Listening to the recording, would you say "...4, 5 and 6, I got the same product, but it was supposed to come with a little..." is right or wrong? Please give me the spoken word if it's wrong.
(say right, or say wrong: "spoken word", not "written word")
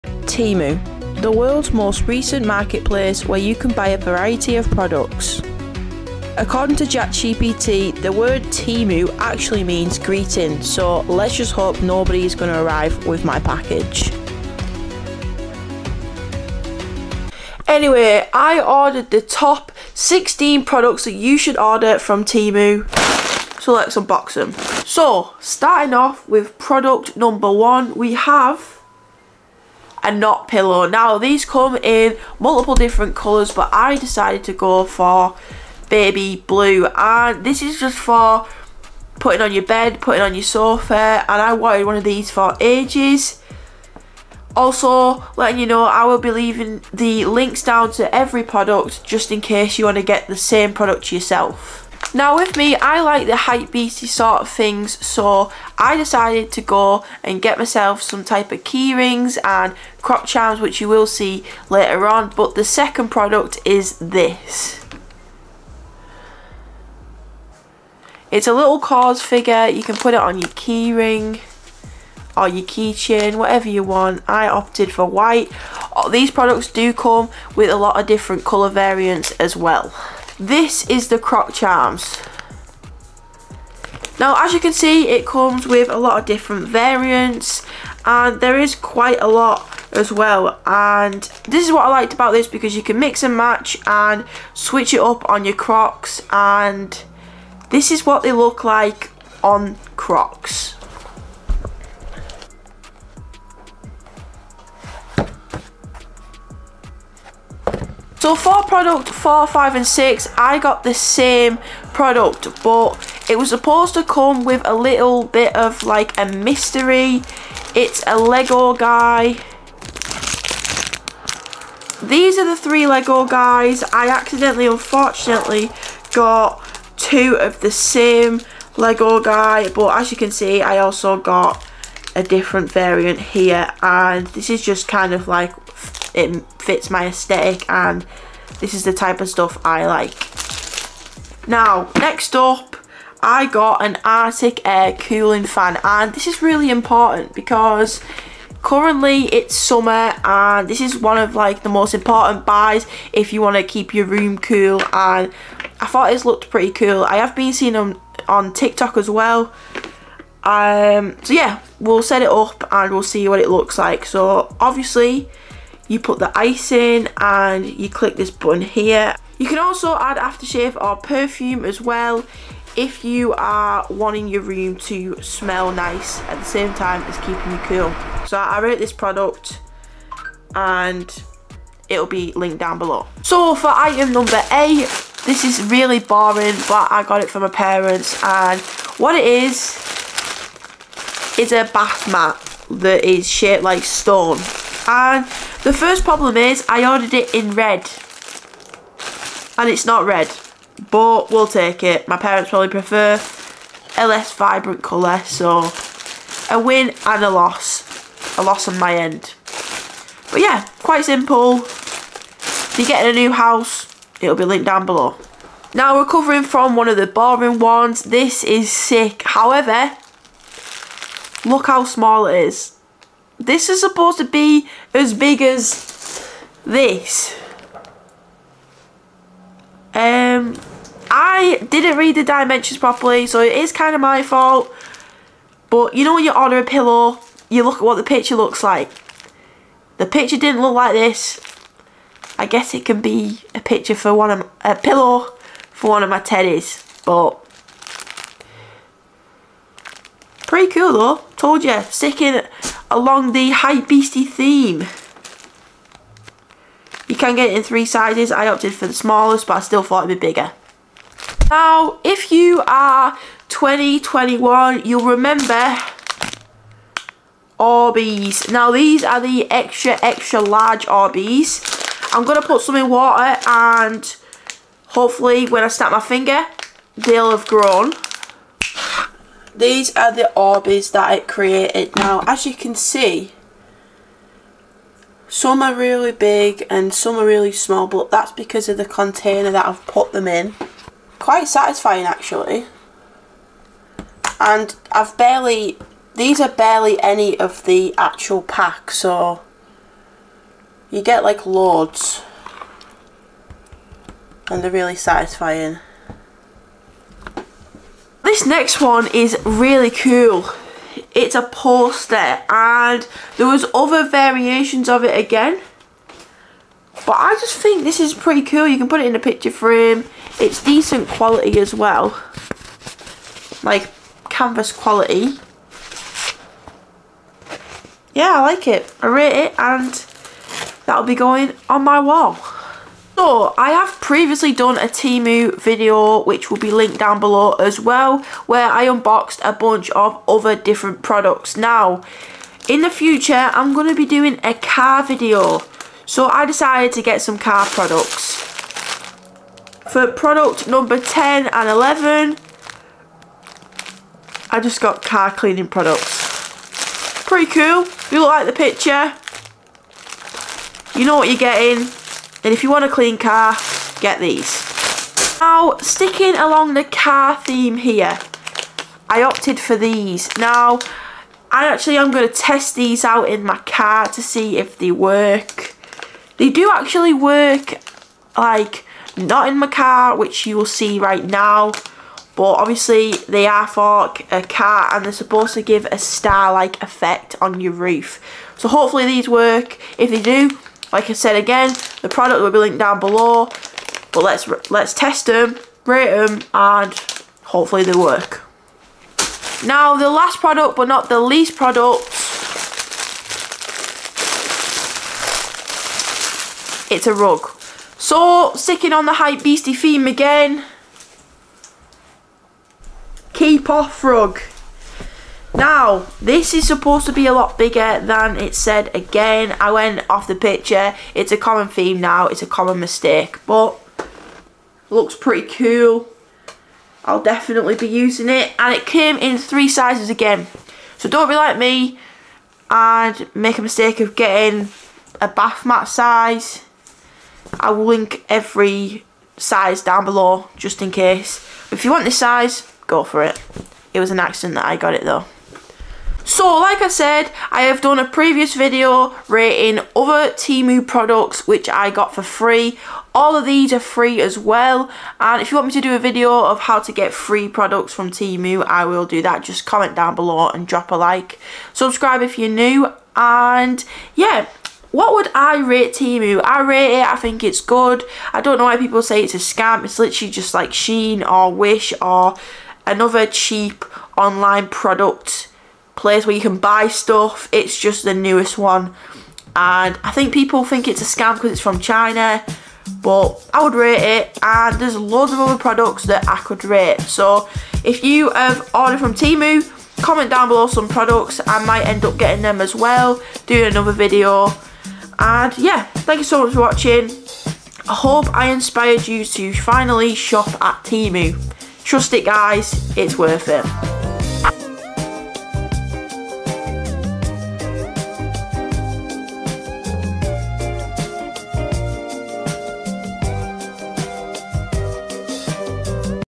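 right.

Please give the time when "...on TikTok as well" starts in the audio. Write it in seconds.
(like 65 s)
158 s.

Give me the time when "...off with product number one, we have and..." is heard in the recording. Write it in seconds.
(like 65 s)
25 s.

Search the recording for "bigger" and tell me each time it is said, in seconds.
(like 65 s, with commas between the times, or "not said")
260 s, 417 s.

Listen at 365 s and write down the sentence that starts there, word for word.
Now, sticking along the car theme here, I opted for these.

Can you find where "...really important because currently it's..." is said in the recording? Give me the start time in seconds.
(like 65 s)
146 s.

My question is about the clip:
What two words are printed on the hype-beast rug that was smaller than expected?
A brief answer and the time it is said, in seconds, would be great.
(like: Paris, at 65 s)
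Keep off, at 413 s.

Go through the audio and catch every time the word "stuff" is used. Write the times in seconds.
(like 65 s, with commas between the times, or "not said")
139 s, 476 s.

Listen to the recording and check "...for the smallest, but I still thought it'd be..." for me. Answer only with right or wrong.
right.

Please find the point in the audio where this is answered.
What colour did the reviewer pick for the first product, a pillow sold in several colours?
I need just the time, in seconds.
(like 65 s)
35 s.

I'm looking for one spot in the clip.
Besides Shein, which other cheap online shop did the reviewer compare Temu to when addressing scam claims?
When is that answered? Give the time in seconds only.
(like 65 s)
471 s.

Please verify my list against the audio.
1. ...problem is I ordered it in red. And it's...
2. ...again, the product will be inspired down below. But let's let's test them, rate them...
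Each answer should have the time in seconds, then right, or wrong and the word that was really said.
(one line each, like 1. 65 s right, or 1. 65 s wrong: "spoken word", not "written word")
1. 196 s right
2. 391 s wrong: "linked", not "inspired".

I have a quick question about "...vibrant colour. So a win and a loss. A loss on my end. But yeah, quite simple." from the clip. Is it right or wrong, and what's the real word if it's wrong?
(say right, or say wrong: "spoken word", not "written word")
right.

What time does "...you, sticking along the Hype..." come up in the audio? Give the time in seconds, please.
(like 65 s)
251 s.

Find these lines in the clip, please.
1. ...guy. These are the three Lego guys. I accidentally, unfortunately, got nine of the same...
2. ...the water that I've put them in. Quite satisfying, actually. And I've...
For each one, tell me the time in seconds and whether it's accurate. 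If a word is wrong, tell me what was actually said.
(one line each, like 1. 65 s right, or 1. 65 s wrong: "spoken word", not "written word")
1. 118 s wrong: "two", not "nine"
2. 288 s wrong: "container", not "water".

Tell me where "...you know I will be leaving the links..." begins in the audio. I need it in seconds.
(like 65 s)
45 s.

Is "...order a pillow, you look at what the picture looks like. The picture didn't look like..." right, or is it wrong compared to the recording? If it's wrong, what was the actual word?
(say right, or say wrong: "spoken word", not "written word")
right.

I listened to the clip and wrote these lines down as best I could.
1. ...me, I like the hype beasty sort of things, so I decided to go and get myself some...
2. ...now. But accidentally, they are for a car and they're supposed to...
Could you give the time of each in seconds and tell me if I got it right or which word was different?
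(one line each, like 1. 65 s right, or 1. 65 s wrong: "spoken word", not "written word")
1. 52 s right
2. 381 s wrong: "obviously", not "accidentally".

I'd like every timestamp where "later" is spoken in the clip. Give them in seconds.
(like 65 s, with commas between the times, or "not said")
61 s.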